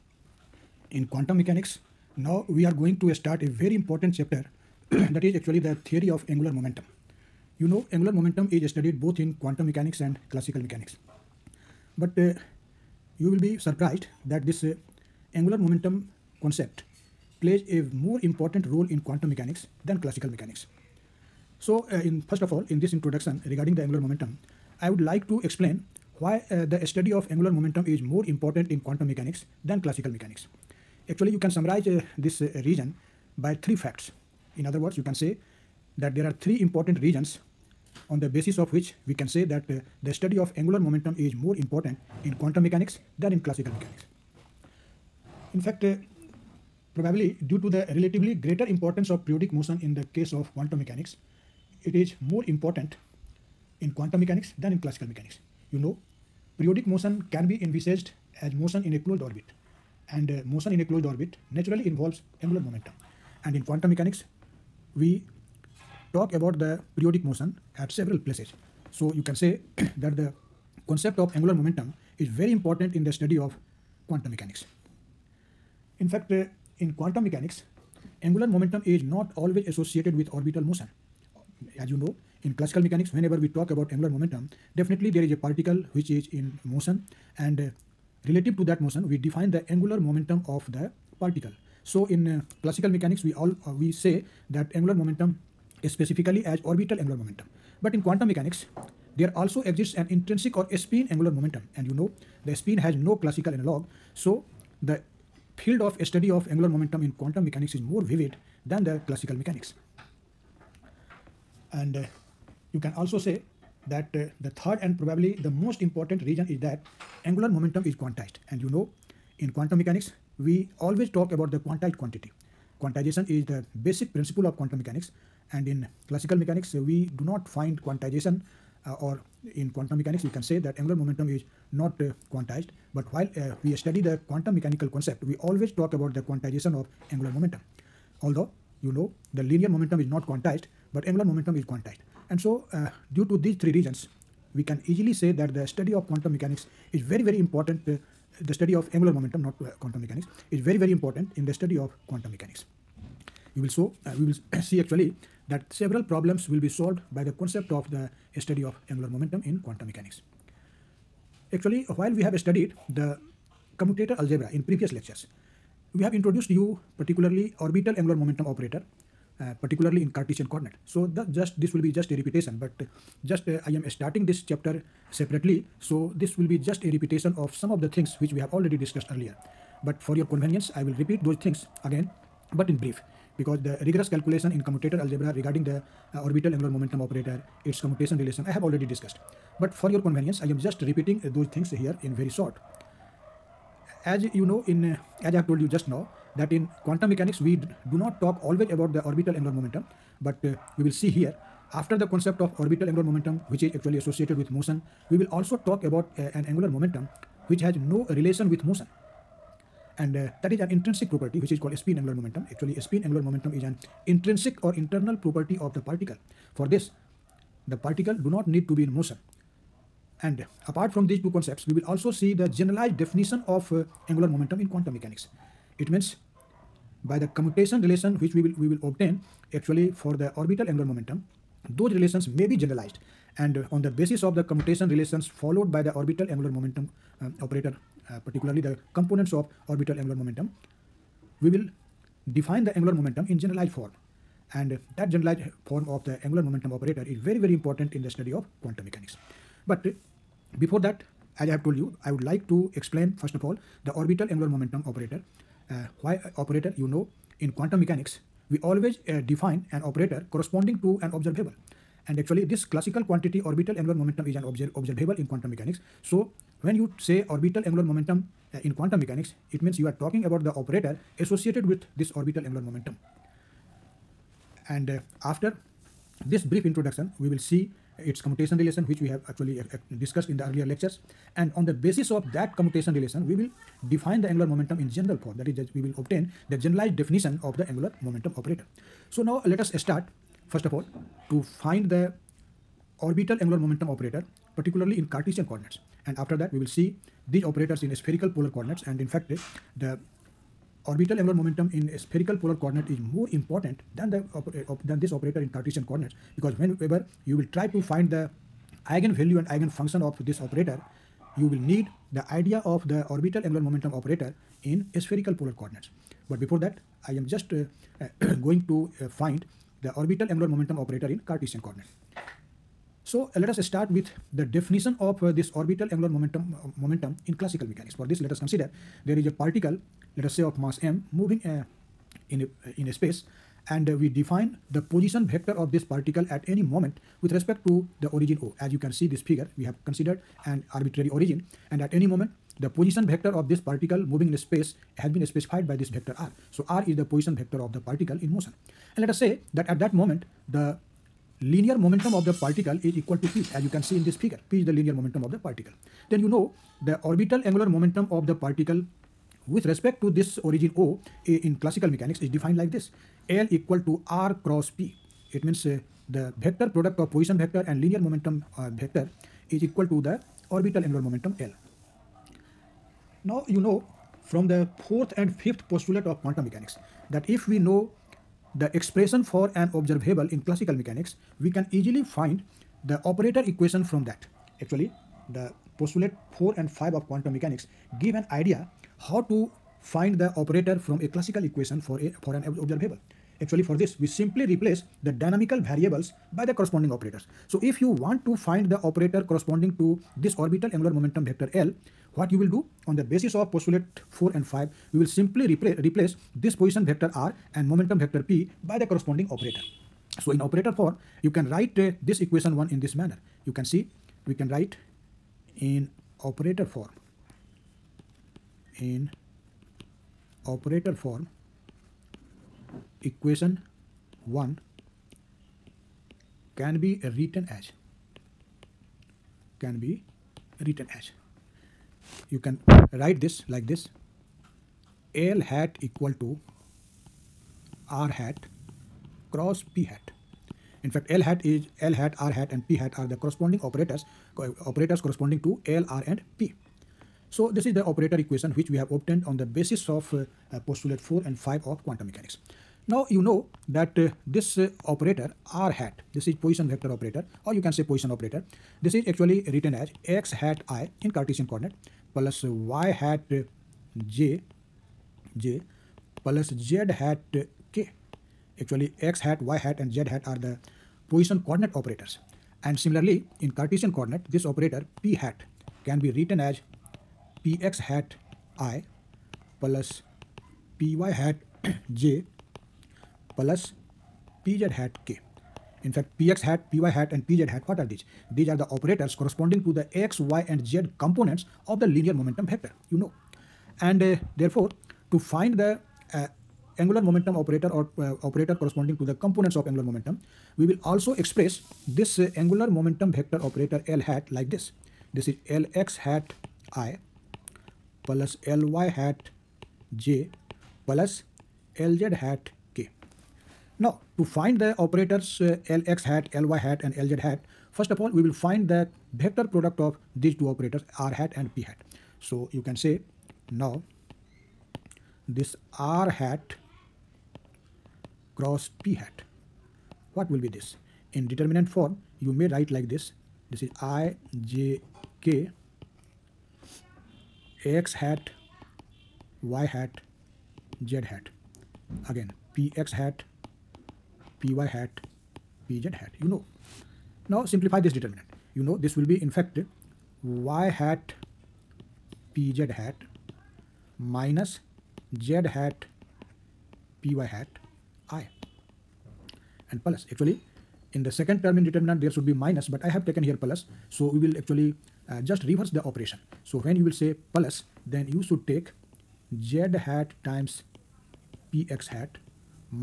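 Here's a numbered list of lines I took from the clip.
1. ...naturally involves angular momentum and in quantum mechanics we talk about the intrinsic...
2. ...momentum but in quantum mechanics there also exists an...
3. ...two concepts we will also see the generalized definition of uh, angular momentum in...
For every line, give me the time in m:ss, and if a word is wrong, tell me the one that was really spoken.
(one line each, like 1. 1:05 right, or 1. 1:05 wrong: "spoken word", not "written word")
1. 1:01 wrong: "periodic", not "intrinsic"
2. 1:37 right
3. 3:41 right.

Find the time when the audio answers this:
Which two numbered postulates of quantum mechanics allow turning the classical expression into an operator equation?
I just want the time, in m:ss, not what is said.
6:14.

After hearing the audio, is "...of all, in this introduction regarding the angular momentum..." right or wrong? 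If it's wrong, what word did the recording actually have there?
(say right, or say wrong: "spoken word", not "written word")
right.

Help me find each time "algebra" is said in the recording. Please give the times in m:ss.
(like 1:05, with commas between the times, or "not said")
2:44, 3:05.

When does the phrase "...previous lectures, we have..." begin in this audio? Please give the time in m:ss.
2:44.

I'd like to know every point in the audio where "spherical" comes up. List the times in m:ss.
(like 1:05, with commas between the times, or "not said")
4:57, 5:01, 5:14.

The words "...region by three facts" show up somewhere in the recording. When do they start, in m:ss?
0:32.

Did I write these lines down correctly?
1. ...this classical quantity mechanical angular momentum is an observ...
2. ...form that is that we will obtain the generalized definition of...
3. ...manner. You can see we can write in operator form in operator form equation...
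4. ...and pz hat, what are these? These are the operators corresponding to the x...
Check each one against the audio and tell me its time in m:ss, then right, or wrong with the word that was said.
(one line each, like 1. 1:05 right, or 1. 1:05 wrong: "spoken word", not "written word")
1. 4:22 wrong: "orbital", not "mechanical"
2. 4:45 right
3. 6:52 right
4. 8:07 right.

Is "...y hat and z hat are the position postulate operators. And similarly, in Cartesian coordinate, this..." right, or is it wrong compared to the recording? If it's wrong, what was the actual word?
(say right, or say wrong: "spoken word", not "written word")
wrong: "coordinate", not "postulate".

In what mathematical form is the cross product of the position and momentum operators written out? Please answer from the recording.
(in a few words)
determinant form.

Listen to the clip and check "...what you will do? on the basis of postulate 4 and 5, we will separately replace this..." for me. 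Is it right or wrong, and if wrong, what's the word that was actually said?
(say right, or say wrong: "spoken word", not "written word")
wrong: "simply", not "separately".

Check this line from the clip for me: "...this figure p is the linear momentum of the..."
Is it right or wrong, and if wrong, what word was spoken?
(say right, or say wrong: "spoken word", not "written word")
right.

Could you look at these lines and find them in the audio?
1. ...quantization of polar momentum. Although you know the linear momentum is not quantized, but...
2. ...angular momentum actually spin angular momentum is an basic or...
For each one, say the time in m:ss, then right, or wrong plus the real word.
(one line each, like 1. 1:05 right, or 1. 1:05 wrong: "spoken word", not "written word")
1. 2:16 wrong: "angular", not "polar"
2. 3:32 wrong: "intrinsic", not "basic".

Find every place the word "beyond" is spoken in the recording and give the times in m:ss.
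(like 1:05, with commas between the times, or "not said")
not said.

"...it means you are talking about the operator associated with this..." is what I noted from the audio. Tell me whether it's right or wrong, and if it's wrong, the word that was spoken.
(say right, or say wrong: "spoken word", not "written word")
right.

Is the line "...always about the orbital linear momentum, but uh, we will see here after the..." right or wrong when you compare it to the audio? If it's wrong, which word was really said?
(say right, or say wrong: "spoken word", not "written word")
wrong: "angular", not "linear".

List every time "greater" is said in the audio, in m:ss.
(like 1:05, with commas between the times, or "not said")
0:48.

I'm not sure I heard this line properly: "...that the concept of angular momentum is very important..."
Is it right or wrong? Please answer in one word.
right.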